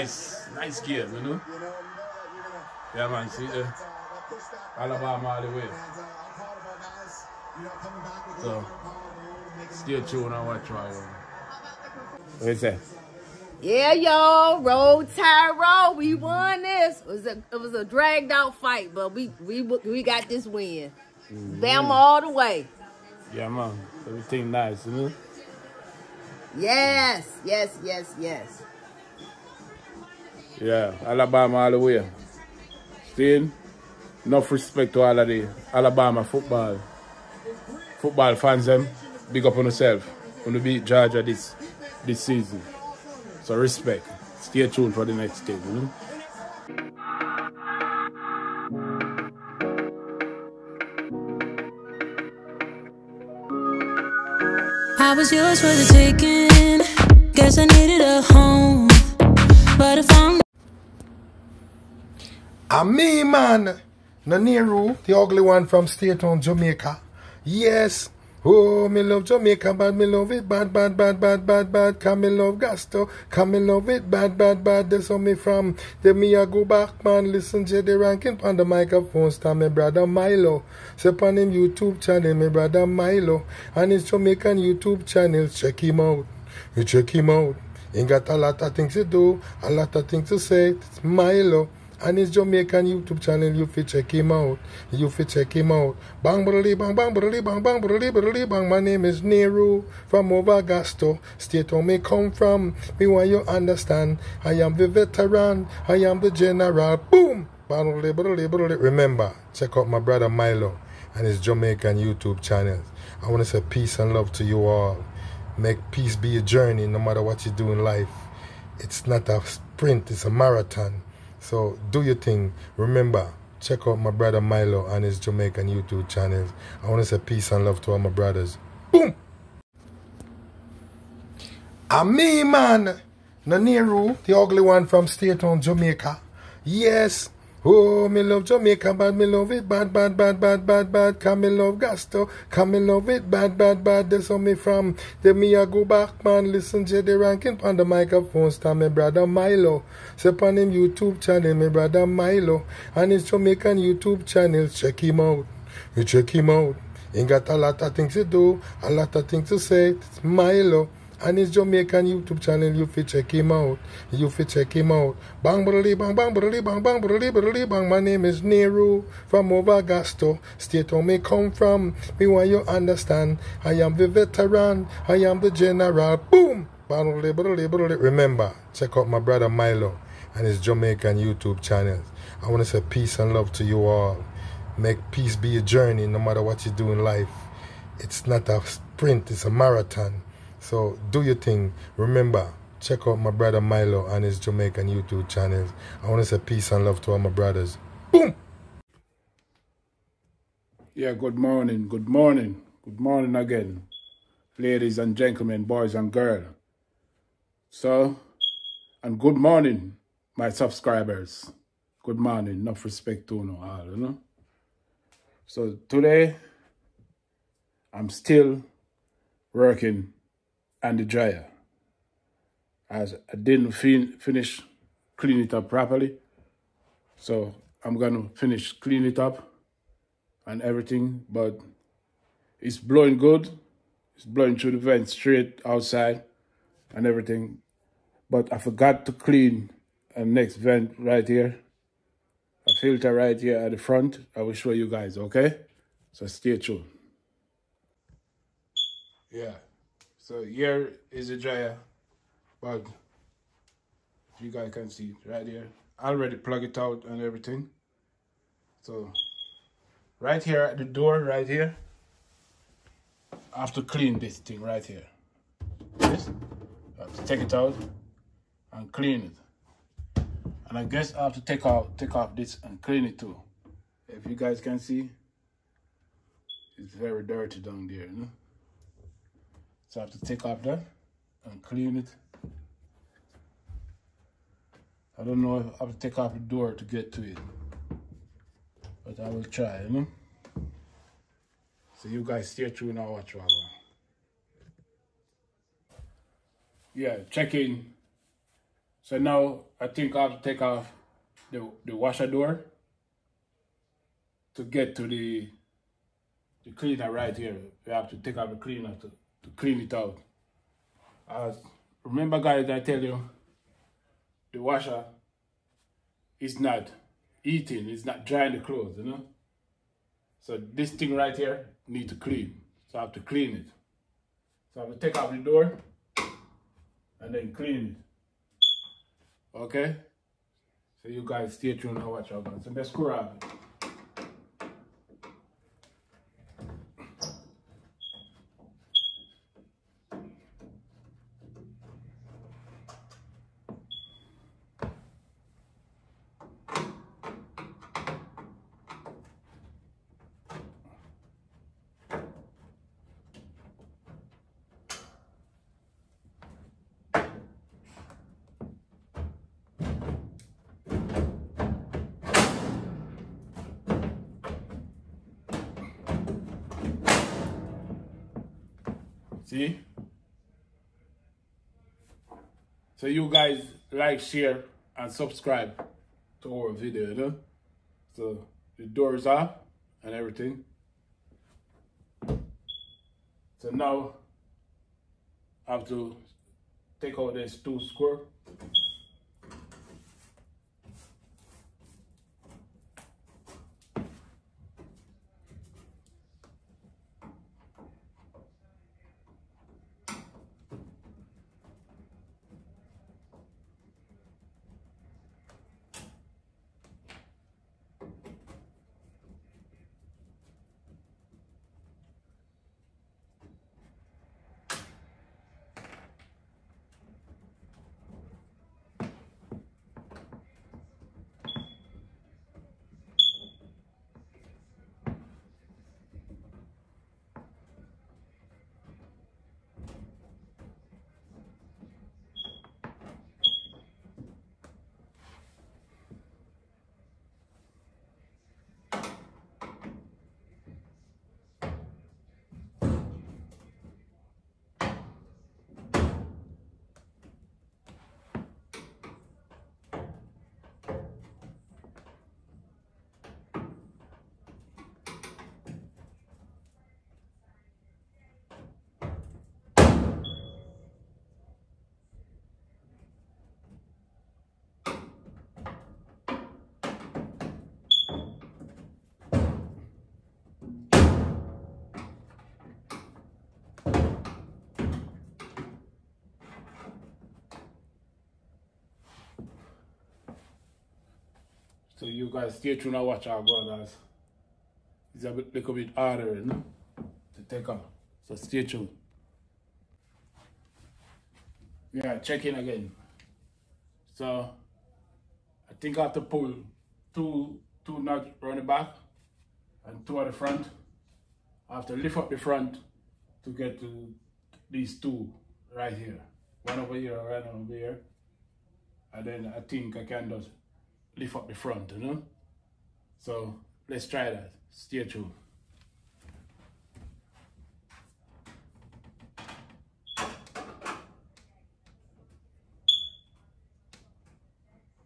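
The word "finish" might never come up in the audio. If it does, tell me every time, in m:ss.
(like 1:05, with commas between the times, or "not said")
3:44, 3:48.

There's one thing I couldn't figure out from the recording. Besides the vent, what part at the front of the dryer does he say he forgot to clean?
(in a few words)
Filter.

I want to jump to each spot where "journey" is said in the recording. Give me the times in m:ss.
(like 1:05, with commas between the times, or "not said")
1:56, 3:05.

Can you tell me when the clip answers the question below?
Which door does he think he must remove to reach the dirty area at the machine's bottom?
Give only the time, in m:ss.
5:01.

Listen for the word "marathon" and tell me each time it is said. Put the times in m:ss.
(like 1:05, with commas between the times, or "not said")
2:00, 3:09.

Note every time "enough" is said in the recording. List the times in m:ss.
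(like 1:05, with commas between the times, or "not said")
0:34, 3:32.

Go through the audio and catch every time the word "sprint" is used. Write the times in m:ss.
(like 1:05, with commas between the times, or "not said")
1:59, 3:08.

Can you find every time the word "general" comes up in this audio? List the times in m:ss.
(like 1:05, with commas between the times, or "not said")
1:46, 2:55.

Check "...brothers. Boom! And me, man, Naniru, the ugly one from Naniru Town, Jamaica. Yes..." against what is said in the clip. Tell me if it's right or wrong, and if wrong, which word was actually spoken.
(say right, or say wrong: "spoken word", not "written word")
wrong: "State", not "Naniru".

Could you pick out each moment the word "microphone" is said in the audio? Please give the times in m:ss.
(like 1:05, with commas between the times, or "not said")
1:18, 2:27.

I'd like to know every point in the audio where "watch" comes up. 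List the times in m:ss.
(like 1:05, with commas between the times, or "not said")
4:53, 5:32, 8:03.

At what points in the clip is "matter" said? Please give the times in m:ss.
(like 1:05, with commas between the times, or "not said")
1:56, 3:06.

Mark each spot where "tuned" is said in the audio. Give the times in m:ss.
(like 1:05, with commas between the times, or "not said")
0:44, 4:06, 4:52, 5:31, 8:02, 8:08, 8:35.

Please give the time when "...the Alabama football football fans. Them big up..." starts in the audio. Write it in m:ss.
0:35.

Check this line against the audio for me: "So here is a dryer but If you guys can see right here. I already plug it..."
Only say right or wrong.
right.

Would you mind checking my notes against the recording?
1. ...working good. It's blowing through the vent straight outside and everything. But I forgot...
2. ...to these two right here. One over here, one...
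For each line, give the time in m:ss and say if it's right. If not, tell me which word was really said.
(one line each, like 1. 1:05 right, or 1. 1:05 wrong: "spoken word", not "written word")
1. 3:52 wrong: "blowing", not "working"
2. 8:23 right.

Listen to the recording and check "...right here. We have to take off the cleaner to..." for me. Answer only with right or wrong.
right.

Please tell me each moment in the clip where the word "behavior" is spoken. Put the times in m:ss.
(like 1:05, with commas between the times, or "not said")
not said.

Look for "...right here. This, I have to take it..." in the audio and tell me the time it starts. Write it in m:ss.
4:24.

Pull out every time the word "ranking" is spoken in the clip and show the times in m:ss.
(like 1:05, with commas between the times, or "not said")
1:17, 2:27.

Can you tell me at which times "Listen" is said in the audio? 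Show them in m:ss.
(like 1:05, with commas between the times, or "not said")
1:17, 2:26.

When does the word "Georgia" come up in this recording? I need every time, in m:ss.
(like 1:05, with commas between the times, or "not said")
0:40.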